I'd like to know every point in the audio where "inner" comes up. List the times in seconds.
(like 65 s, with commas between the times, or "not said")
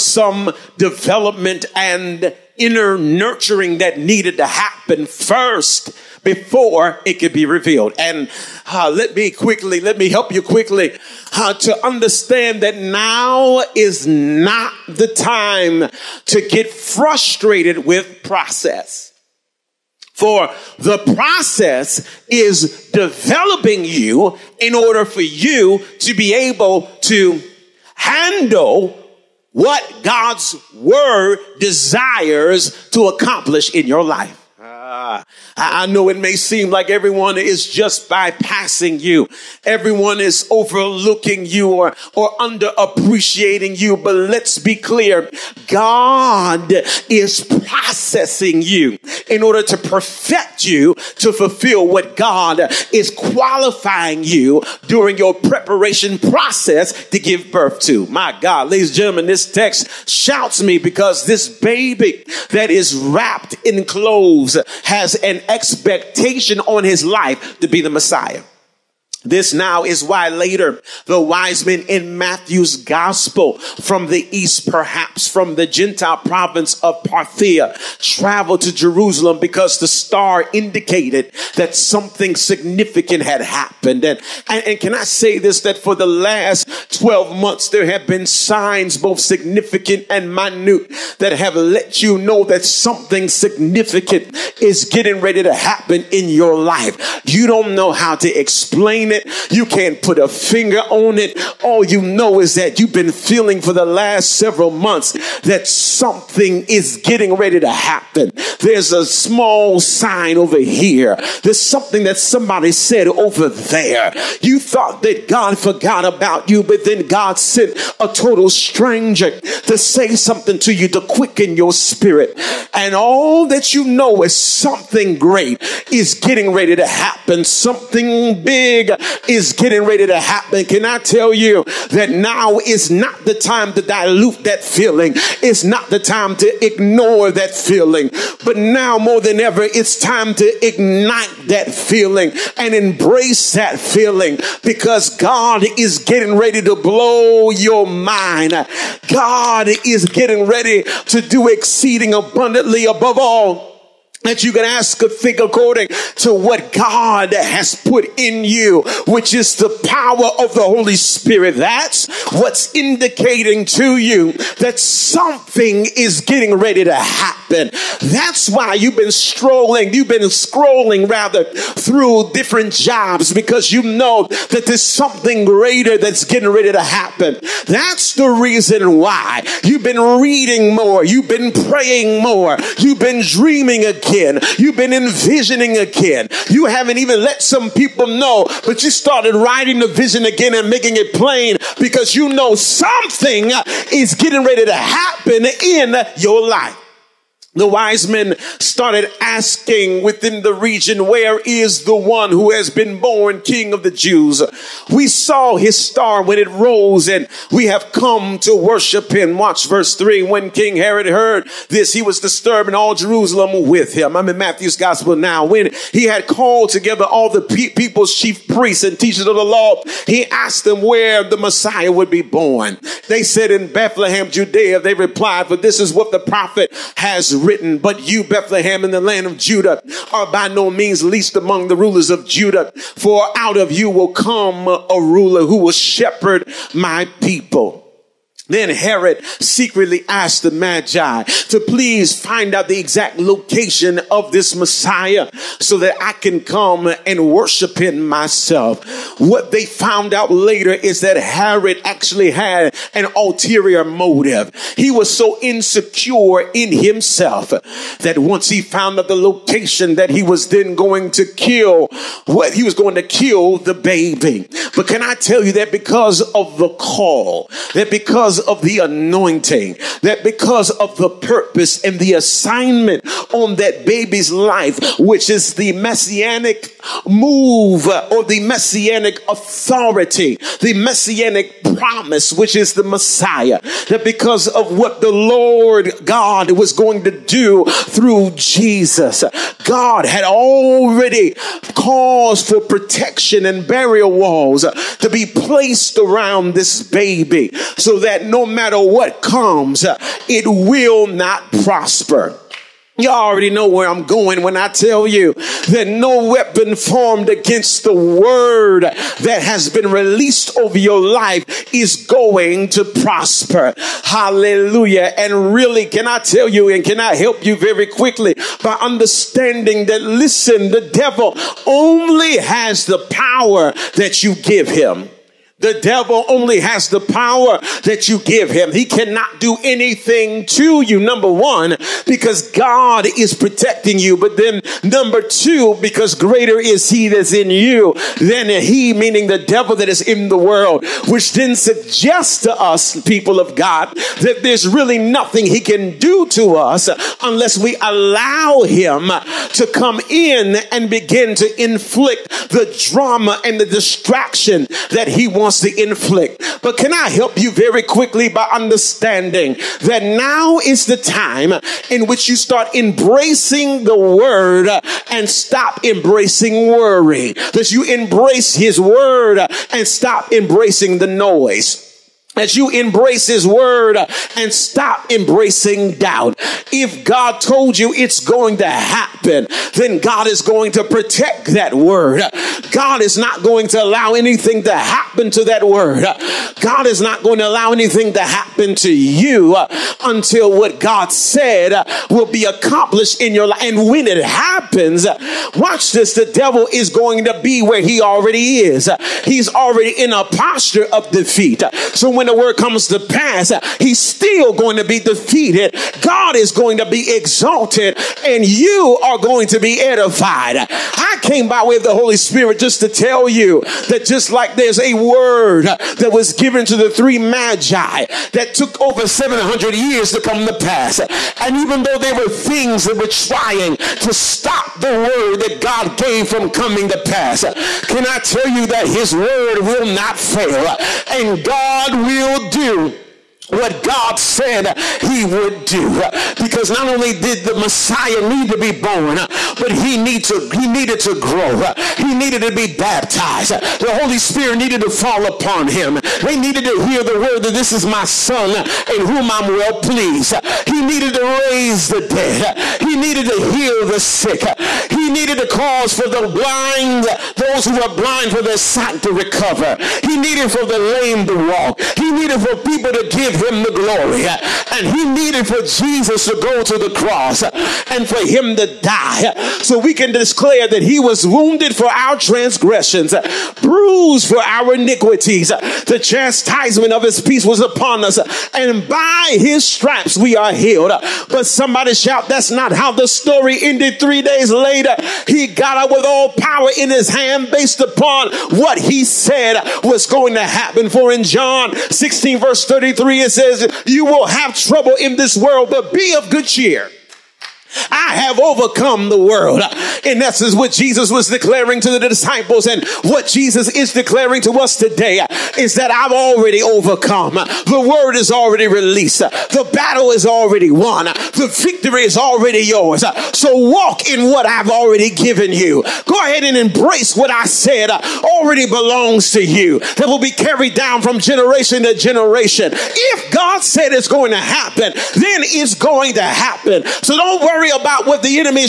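2 s.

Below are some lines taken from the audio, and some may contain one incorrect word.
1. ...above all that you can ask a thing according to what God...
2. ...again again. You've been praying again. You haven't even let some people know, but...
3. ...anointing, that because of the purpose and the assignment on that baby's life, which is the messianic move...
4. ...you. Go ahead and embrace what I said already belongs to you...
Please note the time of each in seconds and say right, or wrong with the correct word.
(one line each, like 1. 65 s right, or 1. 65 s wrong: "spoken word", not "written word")
1. 152 s right
2. 183 s wrong: "envisioning", not "praying"
3. 268 s right
4. 515 s right.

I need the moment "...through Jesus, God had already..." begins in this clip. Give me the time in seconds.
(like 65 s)
287 s.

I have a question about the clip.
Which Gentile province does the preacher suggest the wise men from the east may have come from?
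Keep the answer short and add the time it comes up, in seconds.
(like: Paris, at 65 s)
Parthia, at 77 s.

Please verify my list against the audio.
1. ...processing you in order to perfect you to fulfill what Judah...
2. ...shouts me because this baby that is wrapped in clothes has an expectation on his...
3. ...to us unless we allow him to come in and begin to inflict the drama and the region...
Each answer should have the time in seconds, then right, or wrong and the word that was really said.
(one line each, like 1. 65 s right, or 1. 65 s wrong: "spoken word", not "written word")
1. 47 s wrong: "God", not "Judah"
2. 60 s right
3. 346 s wrong: "distraction", not "region".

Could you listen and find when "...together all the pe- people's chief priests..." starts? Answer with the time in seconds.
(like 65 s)
216 s.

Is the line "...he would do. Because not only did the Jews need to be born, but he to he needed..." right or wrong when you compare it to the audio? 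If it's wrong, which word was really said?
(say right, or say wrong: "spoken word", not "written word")
wrong: "Messiah", not "Jews".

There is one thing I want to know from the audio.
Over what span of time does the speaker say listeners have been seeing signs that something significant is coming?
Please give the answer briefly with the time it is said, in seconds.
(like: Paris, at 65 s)
12 months, at 86 s.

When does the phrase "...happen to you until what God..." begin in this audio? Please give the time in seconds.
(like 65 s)
388 s.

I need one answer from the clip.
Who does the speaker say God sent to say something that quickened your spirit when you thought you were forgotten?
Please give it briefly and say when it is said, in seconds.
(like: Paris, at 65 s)
A total stranger, at 117 s.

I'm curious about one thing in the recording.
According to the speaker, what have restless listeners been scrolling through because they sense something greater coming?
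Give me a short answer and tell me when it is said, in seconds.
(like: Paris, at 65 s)
Different jobs, at 172 s.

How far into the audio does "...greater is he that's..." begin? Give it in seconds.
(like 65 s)
336 s.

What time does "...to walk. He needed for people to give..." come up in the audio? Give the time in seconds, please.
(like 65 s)
461 s.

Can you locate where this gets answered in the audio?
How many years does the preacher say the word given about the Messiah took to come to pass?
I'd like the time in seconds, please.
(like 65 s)
419 s.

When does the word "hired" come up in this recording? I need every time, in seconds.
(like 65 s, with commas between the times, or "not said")
not said.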